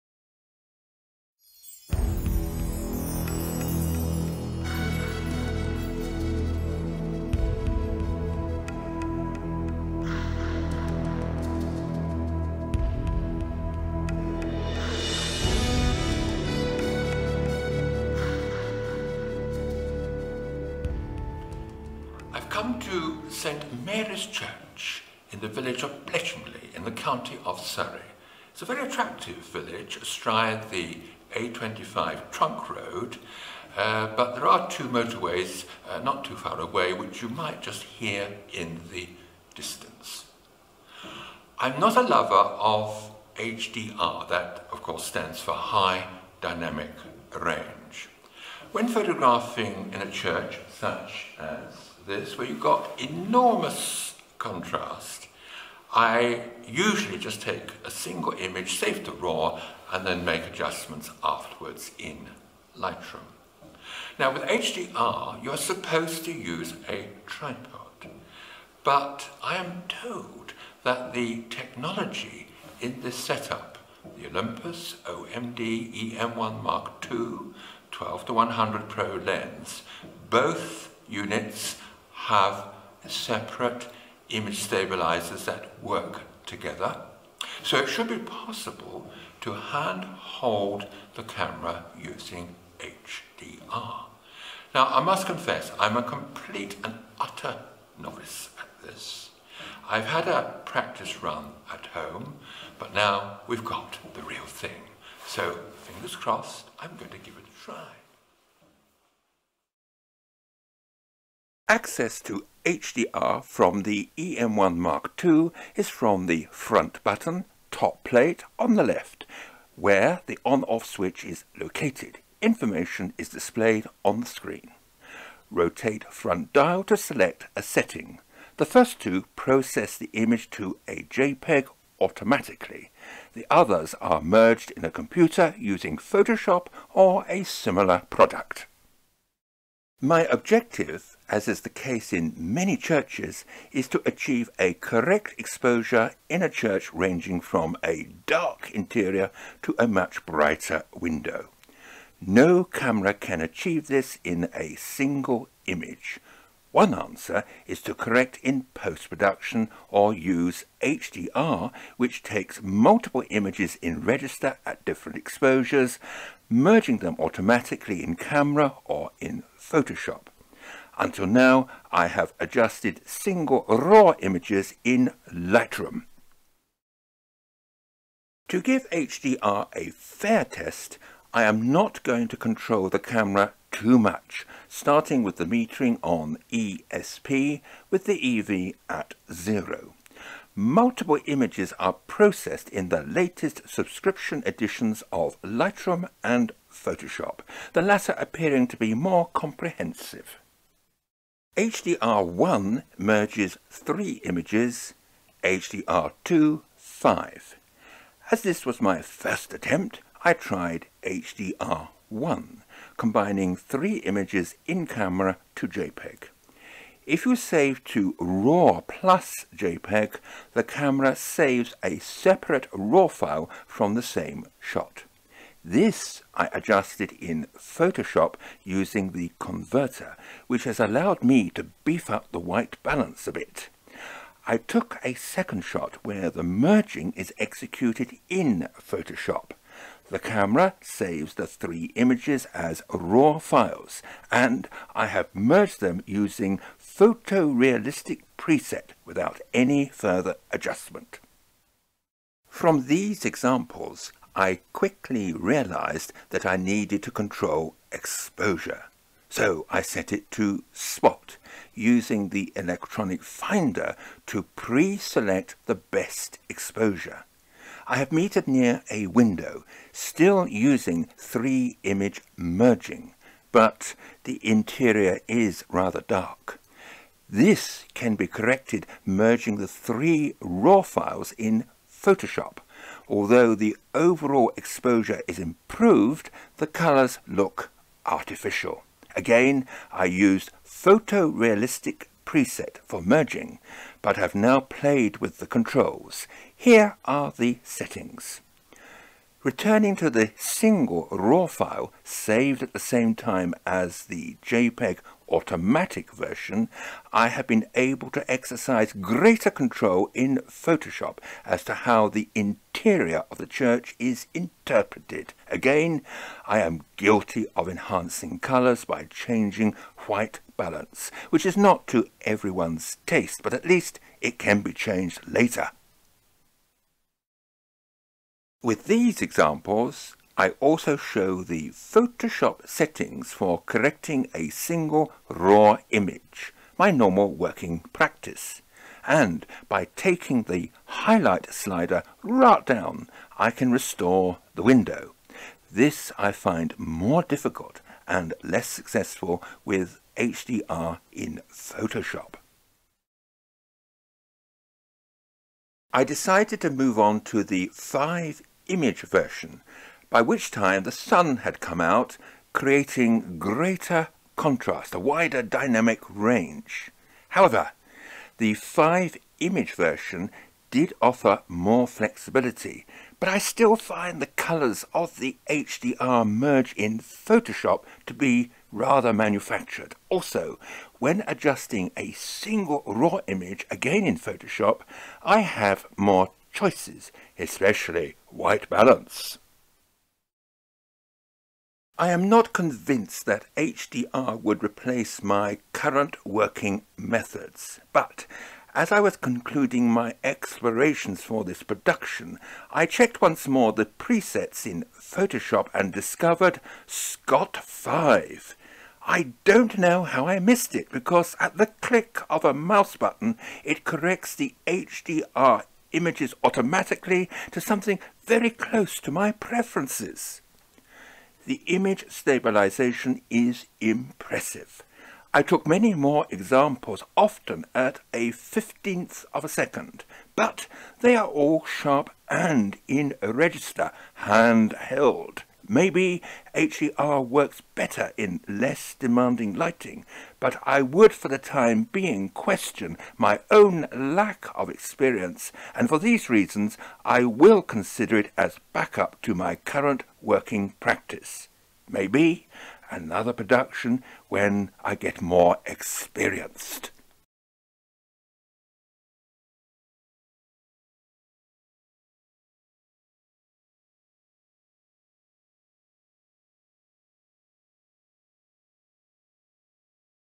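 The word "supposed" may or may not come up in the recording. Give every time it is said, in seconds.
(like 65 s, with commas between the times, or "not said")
65 s.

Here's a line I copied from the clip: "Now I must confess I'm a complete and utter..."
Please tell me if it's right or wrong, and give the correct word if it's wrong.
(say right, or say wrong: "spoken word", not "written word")
right.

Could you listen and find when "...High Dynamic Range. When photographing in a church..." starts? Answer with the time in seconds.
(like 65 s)
45 s.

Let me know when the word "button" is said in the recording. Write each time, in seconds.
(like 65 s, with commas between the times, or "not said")
117 s, 412 s.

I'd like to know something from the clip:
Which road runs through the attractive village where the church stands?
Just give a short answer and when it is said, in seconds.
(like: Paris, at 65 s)
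A25, at 31 s.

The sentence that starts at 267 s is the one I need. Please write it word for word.
I have metered near a window, still using three image merging, but the interior is rather dark.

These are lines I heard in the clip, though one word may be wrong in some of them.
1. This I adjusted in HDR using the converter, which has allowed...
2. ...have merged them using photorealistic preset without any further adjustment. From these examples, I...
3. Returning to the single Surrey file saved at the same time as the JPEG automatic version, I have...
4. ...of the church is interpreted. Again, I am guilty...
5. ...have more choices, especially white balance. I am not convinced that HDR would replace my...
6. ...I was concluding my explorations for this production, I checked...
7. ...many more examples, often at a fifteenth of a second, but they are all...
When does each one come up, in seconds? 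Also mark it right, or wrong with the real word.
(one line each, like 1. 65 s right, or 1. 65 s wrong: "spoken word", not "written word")
1. 225 s wrong: "Photoshop", not "HDR"
2. 245 s right
3. 299 s wrong: "RAW", not "Surrey"
4. 313 s right
5. 385 s right
6. 398 s right
7. 425 s right.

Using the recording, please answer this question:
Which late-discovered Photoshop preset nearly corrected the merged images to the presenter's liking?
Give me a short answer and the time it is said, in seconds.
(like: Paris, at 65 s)
Scott 5, at 406 s.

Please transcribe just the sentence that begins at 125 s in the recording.
Rotate front dial to select a setting.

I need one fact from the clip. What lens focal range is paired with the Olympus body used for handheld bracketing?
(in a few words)
12 to 100.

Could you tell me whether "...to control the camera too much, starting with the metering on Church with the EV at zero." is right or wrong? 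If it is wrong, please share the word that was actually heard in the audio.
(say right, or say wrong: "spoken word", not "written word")
wrong: "ESP", not "Church".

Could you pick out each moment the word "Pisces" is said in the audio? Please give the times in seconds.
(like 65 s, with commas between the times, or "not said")
not said.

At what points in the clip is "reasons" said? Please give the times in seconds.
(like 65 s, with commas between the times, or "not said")
446 s.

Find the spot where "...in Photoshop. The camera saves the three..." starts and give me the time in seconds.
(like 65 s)
238 s.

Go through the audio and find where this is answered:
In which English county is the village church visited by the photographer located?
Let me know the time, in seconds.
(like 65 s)
27 s.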